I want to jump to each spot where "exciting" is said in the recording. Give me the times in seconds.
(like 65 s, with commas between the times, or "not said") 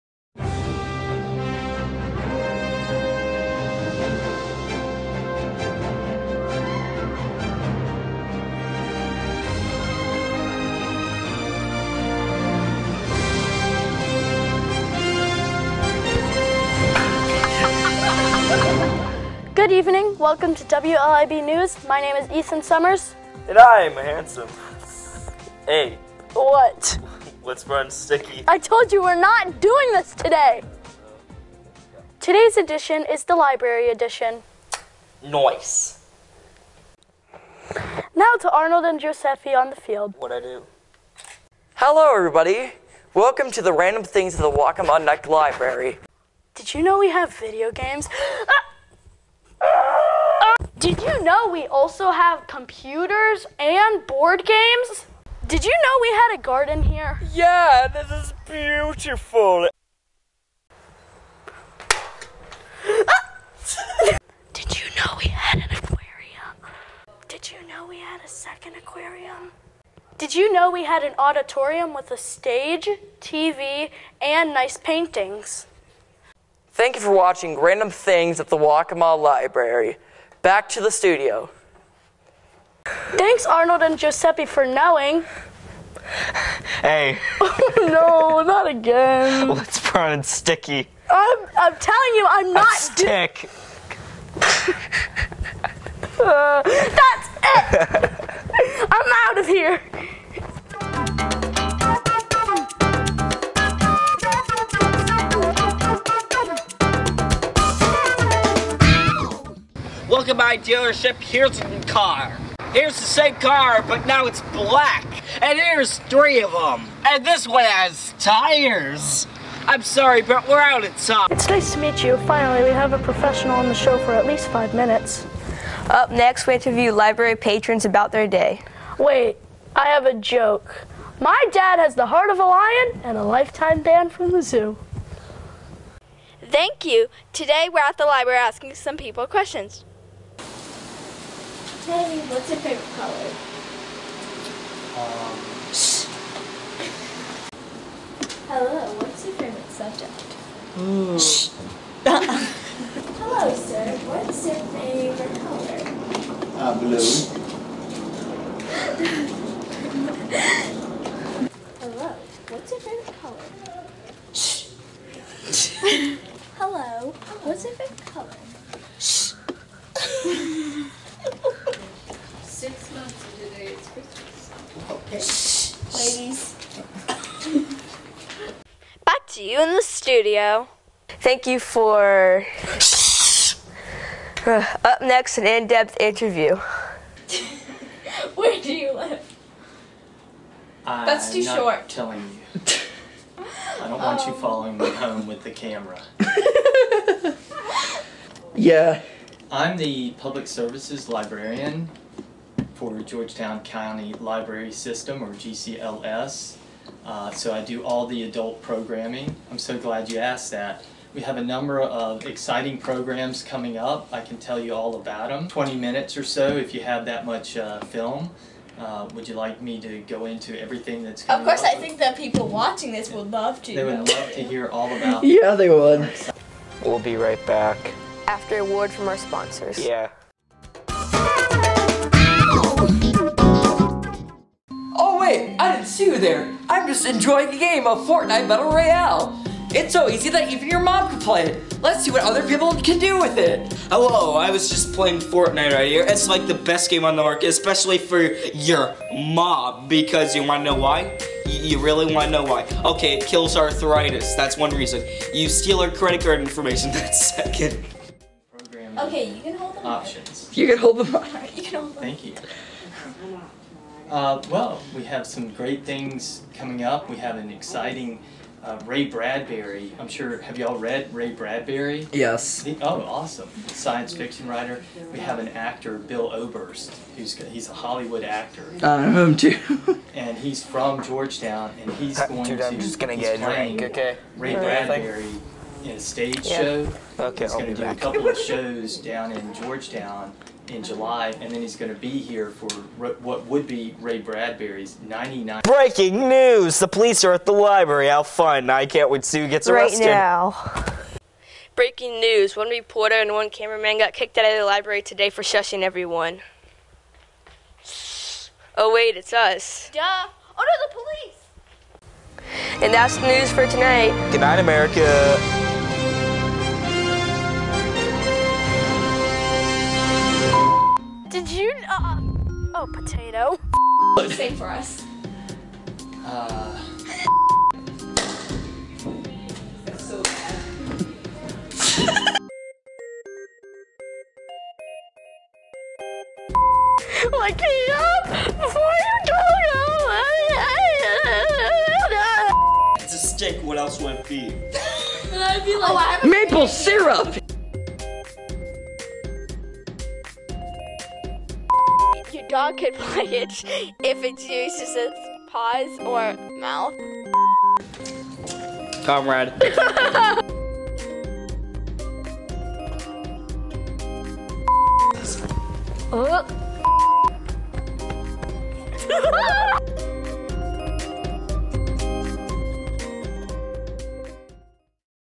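212 s, 267 s.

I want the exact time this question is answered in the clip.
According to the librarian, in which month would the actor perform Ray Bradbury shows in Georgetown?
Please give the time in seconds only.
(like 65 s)
290 s.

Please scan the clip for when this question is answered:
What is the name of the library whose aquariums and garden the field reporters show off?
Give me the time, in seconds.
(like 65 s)
44 s.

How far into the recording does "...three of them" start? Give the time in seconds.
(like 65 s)
115 s.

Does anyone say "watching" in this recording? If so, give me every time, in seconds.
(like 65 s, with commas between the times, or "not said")
77 s, 222 s.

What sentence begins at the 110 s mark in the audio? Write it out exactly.
Look at my dealership, here's a car.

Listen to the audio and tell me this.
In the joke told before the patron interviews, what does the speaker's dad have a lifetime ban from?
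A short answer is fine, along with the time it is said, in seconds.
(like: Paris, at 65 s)
the zoo, at 134 s.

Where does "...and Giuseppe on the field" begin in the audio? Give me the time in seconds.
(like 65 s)
38 s.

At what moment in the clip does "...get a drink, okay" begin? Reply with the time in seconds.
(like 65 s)
283 s.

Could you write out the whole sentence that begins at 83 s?
Thanks, Arnold and Giuseppe, for knowing.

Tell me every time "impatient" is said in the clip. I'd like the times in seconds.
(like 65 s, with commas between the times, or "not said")
not said.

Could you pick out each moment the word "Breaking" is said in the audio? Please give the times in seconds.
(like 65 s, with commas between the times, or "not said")
295 s, 301 s.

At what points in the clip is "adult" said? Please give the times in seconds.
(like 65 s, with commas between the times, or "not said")
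208 s.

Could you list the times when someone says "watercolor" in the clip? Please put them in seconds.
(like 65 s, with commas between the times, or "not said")
not said.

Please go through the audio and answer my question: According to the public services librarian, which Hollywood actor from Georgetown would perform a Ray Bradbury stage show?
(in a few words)
Bill Oberst.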